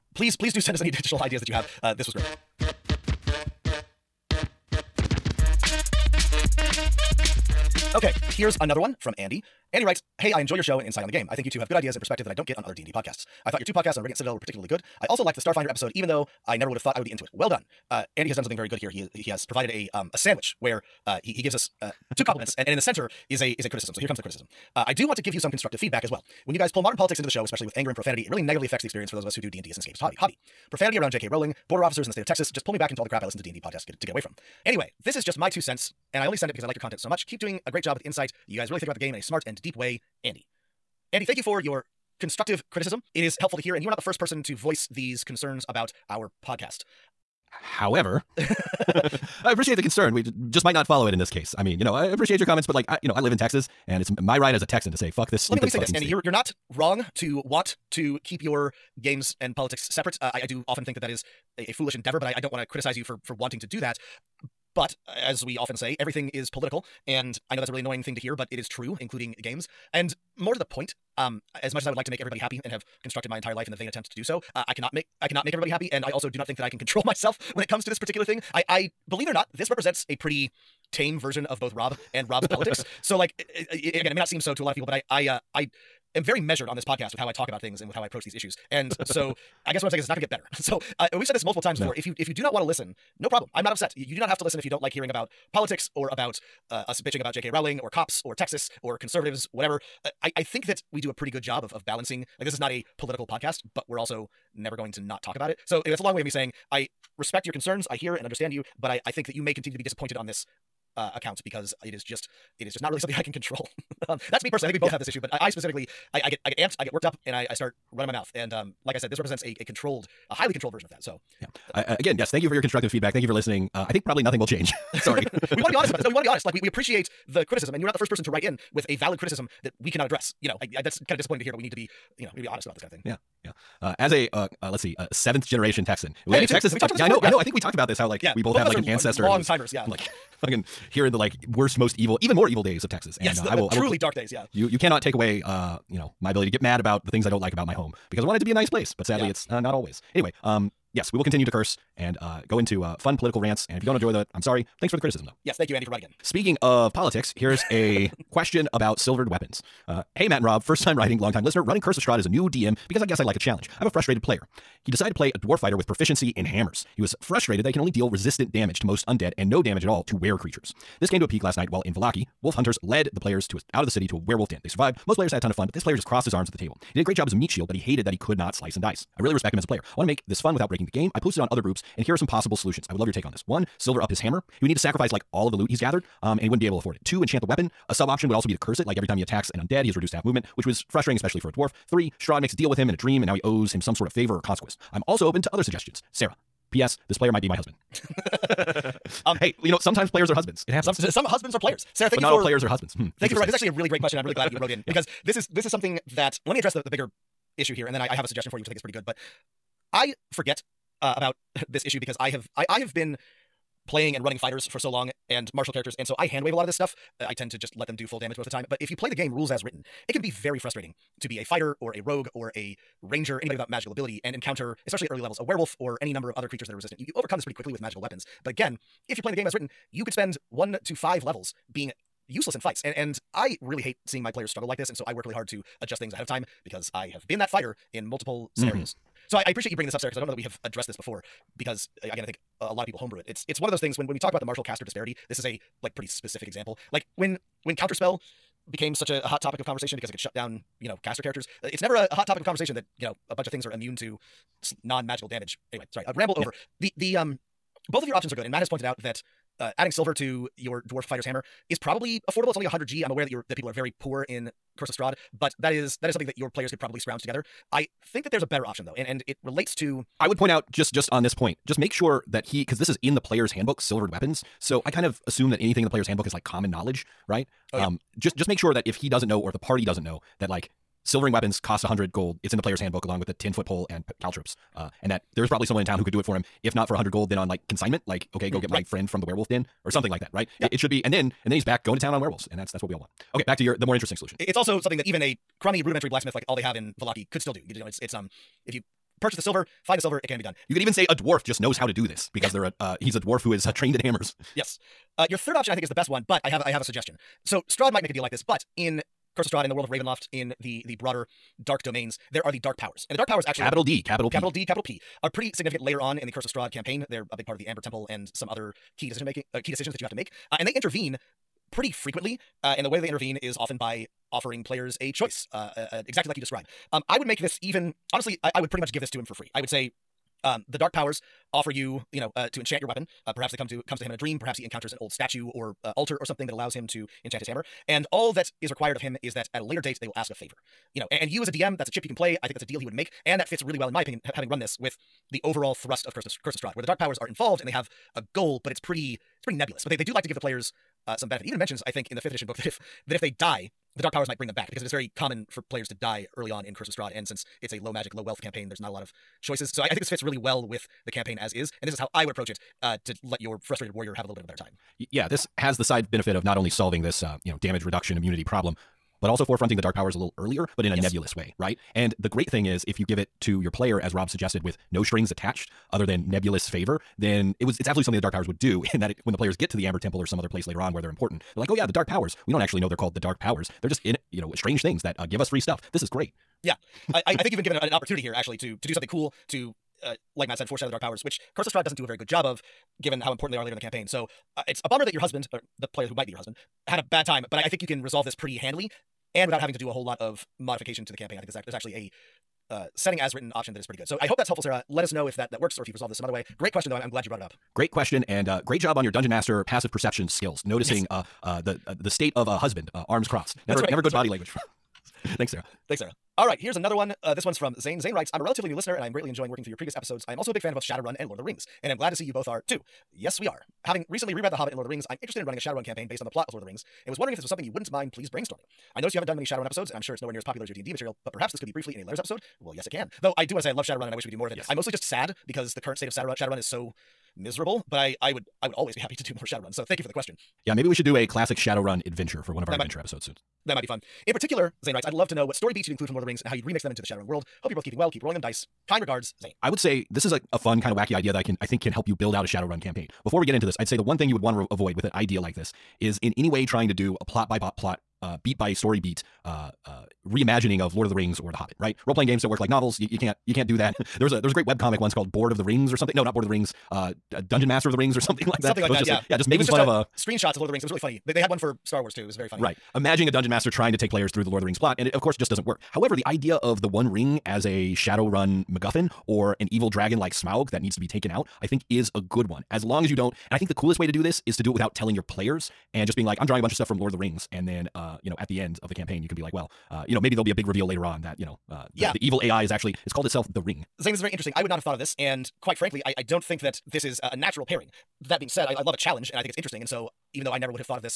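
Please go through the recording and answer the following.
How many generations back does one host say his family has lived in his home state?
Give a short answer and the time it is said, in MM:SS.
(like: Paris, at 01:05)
7, at 02:15.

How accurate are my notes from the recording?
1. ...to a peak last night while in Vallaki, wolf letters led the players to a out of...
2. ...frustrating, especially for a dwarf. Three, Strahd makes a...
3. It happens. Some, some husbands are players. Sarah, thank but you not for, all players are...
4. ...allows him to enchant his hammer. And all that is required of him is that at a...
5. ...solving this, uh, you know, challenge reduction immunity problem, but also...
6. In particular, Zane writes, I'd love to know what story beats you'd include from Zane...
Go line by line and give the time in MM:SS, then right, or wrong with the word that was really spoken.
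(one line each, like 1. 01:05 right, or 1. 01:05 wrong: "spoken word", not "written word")
1. 02:51 wrong: "hunters", not "letters"
2. 03:10 right
3. 03:20 right
4. 05:36 right
5. 06:06 wrong: "damage", not "challenge"
6. 07:24 wrong: "Lord", not "Zane".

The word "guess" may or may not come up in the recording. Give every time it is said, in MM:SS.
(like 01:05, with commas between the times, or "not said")
01:29, 02:43.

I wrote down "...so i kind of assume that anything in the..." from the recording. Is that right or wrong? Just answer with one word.
right.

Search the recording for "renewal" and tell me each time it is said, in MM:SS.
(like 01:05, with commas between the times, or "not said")
not said.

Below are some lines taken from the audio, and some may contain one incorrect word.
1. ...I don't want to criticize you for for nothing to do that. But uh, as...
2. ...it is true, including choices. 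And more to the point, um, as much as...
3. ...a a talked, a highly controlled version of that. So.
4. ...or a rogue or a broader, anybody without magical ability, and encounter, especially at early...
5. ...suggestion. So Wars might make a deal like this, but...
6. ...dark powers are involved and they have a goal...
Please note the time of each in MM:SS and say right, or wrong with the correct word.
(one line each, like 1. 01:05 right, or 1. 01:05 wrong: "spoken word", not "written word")
1. 01:02 wrong: "wanting", not "nothing"
2. 01:08 wrong: "games", not "choices"
3. 01:59 wrong: "controlled", not "talked"
4. 03:41 wrong: "ranger", not "broader"
5. 05:06 wrong: "Strahd", not "Wars"
6. 05:46 right.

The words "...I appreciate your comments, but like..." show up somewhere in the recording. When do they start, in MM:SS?
00:51.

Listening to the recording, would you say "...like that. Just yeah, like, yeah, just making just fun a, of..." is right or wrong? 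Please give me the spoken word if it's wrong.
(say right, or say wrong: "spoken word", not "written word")
right.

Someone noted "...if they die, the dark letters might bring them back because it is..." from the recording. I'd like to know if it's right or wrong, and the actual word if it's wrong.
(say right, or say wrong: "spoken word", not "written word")
wrong: "powers", not "letters".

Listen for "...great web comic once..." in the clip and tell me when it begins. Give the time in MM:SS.
07:44.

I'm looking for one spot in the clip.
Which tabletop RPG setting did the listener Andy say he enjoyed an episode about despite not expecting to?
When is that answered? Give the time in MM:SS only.
00:15.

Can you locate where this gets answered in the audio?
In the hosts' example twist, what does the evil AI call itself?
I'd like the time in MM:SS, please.
08:13.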